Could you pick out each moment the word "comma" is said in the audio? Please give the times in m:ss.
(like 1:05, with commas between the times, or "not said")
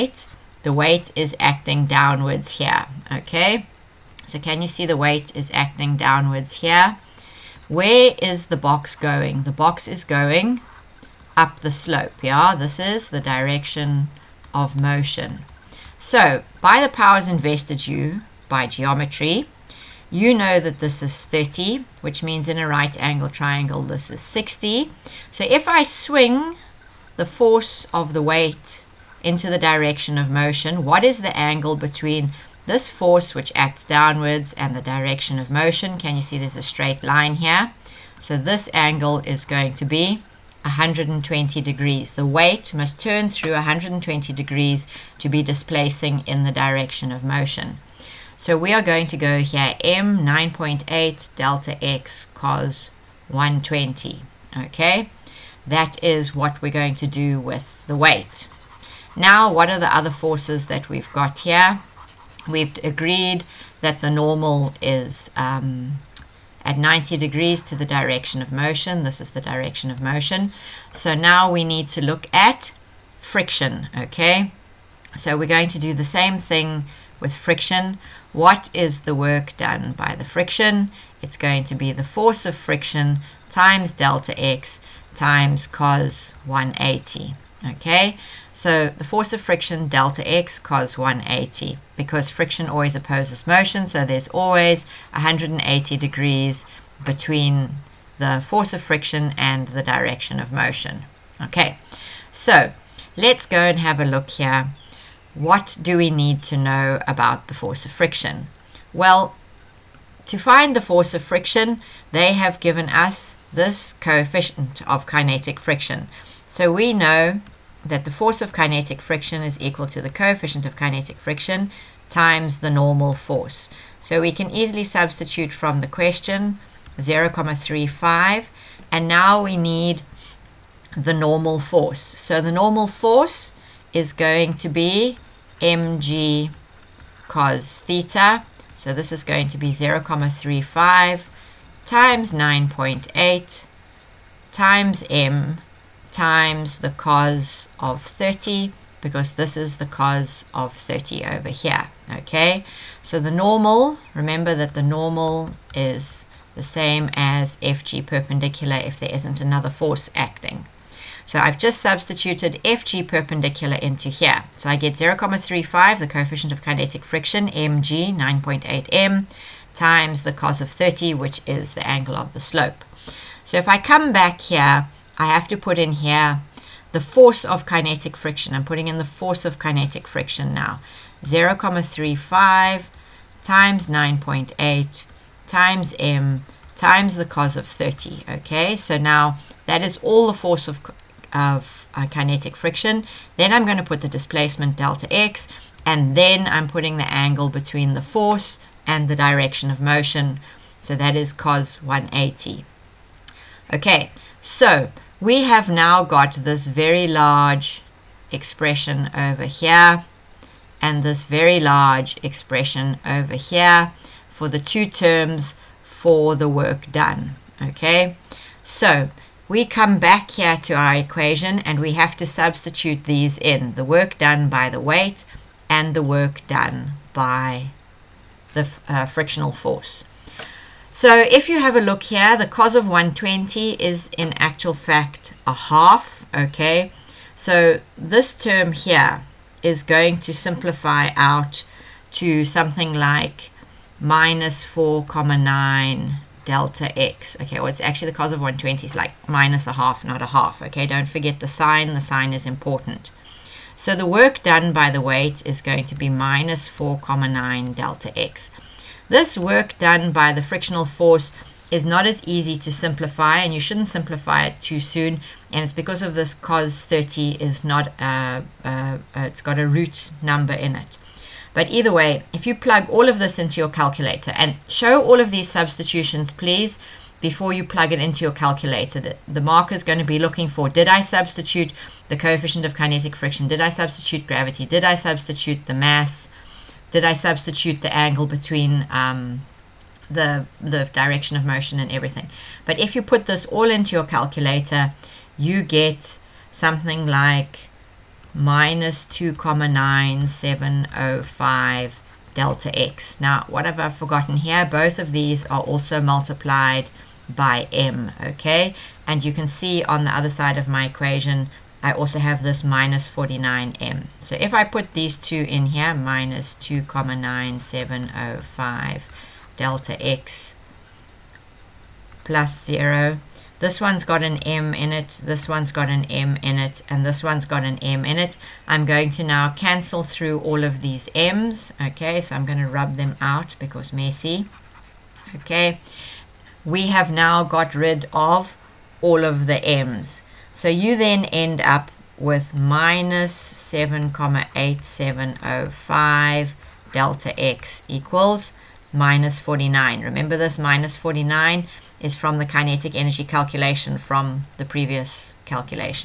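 4:05, 4:16, 5:16.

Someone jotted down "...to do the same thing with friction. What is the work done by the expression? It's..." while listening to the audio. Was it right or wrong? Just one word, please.
wrong.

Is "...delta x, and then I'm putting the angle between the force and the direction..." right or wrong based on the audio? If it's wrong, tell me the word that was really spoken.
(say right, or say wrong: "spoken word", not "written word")
right.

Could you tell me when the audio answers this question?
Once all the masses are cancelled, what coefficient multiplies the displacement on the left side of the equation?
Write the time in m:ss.
5:42.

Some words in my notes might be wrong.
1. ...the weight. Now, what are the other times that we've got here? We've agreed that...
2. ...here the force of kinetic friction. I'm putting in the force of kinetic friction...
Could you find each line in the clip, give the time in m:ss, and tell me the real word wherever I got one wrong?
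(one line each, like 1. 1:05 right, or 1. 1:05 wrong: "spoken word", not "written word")
1. 0:57 wrong: "forces", not "times"
2. 2:55 right.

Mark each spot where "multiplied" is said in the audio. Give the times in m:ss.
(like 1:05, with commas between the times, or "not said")
5:05.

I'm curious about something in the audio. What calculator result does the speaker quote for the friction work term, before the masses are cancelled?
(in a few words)
-2.9705 delta x.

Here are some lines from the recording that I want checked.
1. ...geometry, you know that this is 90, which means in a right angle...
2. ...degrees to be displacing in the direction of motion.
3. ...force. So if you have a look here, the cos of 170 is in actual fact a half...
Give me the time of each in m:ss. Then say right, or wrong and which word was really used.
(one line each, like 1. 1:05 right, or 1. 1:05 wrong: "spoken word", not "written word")
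1. 0:18 wrong: "30", not "90"
2. 0:44 right
3. 3:49 wrong: "120", not "170".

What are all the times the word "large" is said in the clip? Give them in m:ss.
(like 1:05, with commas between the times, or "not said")
3:27, 3:31.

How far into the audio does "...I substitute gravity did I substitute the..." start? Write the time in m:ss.
4:43.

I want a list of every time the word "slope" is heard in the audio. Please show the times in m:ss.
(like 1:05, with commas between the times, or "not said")
0:11, 2:52.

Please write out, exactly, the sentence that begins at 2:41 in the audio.
So I've just substituted FG perpendicular into here.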